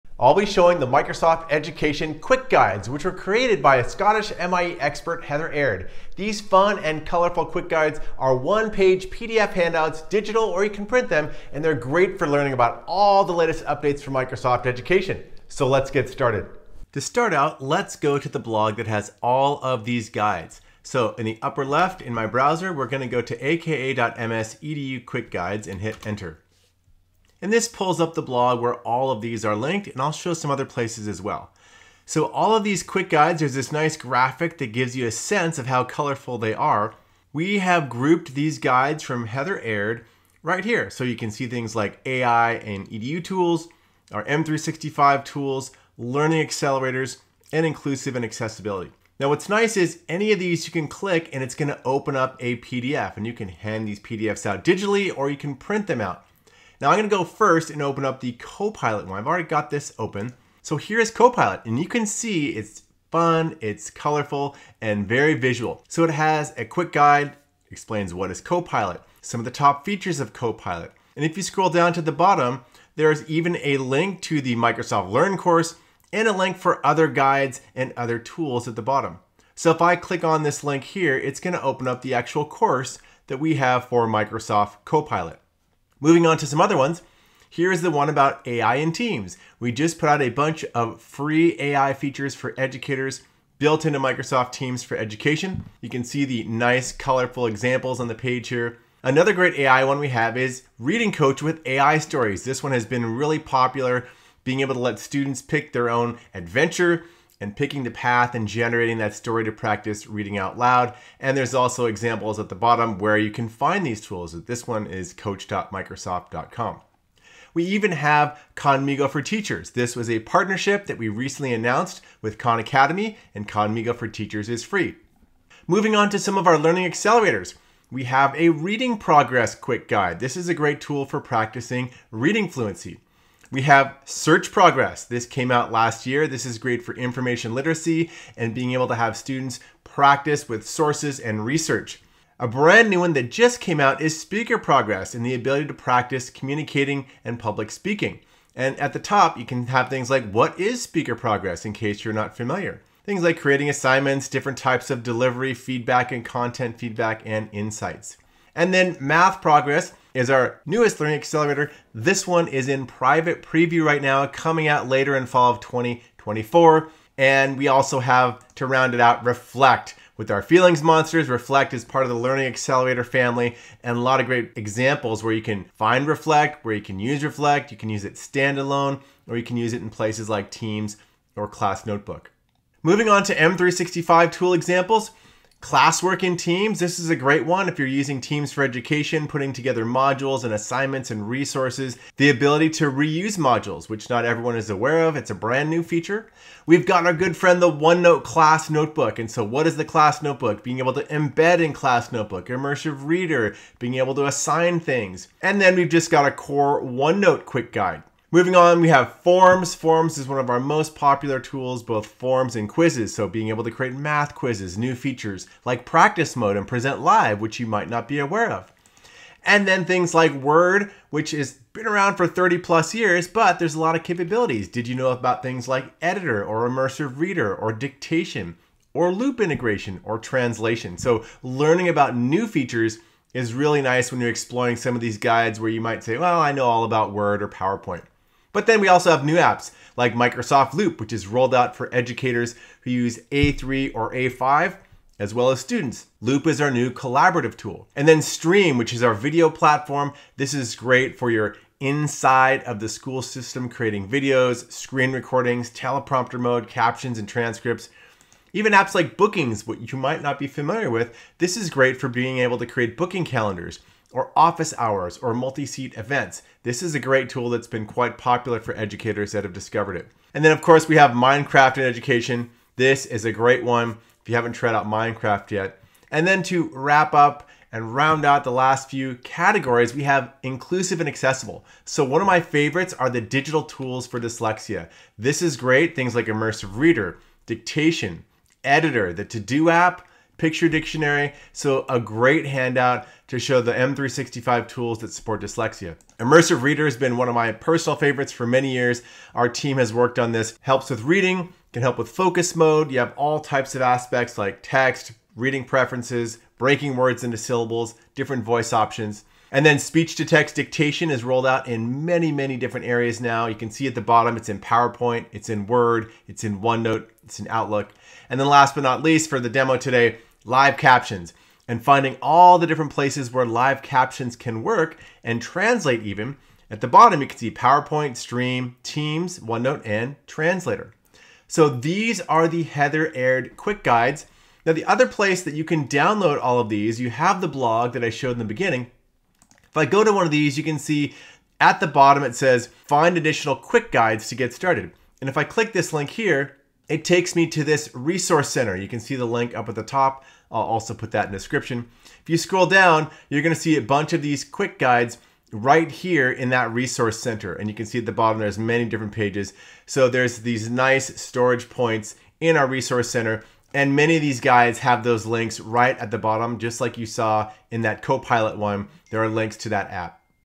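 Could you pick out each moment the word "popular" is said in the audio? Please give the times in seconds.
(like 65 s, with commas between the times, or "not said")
103 s, 210 s, 268 s.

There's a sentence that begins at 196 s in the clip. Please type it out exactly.
We've got our good friend the OneNote Class Notebook.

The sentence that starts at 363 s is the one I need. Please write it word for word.
And many of these guides have those links right at the bottom, just like you saw in that Copilot one.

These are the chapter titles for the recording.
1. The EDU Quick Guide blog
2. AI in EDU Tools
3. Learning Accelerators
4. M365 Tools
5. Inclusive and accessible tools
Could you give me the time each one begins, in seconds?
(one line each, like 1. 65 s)
1. 17 s
2. 58 s
3. 125 s
4. 183 s
5. 280 s.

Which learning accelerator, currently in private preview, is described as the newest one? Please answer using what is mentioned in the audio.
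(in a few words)
Math Progress.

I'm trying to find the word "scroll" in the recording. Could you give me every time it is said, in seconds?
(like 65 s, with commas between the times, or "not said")
71 s, 352 s.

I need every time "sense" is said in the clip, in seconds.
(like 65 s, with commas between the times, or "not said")
35 s.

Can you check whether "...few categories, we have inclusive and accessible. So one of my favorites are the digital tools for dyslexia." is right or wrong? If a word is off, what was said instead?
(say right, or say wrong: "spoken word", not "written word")
right.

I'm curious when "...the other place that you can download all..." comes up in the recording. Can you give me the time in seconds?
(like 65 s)
334 s.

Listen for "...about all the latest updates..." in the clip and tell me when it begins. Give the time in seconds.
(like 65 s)
12 s.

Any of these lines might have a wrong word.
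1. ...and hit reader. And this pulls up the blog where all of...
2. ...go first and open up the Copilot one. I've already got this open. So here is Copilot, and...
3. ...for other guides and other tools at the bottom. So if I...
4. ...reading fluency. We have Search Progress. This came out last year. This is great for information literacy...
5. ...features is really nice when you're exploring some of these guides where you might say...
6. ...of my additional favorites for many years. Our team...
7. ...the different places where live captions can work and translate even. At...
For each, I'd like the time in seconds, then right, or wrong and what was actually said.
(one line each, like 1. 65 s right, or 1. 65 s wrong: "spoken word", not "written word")
1. 25 s wrong: "enter", not "reader"
2. 57 s right
3. 76 s right
4. 132 s right
5. 232 s right
6. 297 s wrong: "personal", not "additional"
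7. 322 s right.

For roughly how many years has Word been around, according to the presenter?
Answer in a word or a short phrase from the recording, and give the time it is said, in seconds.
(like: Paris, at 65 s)
30 plus years, at 222 s.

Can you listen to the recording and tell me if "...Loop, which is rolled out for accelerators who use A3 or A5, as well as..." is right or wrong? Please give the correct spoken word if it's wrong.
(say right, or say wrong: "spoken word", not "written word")
wrong: "educators", not "accelerators".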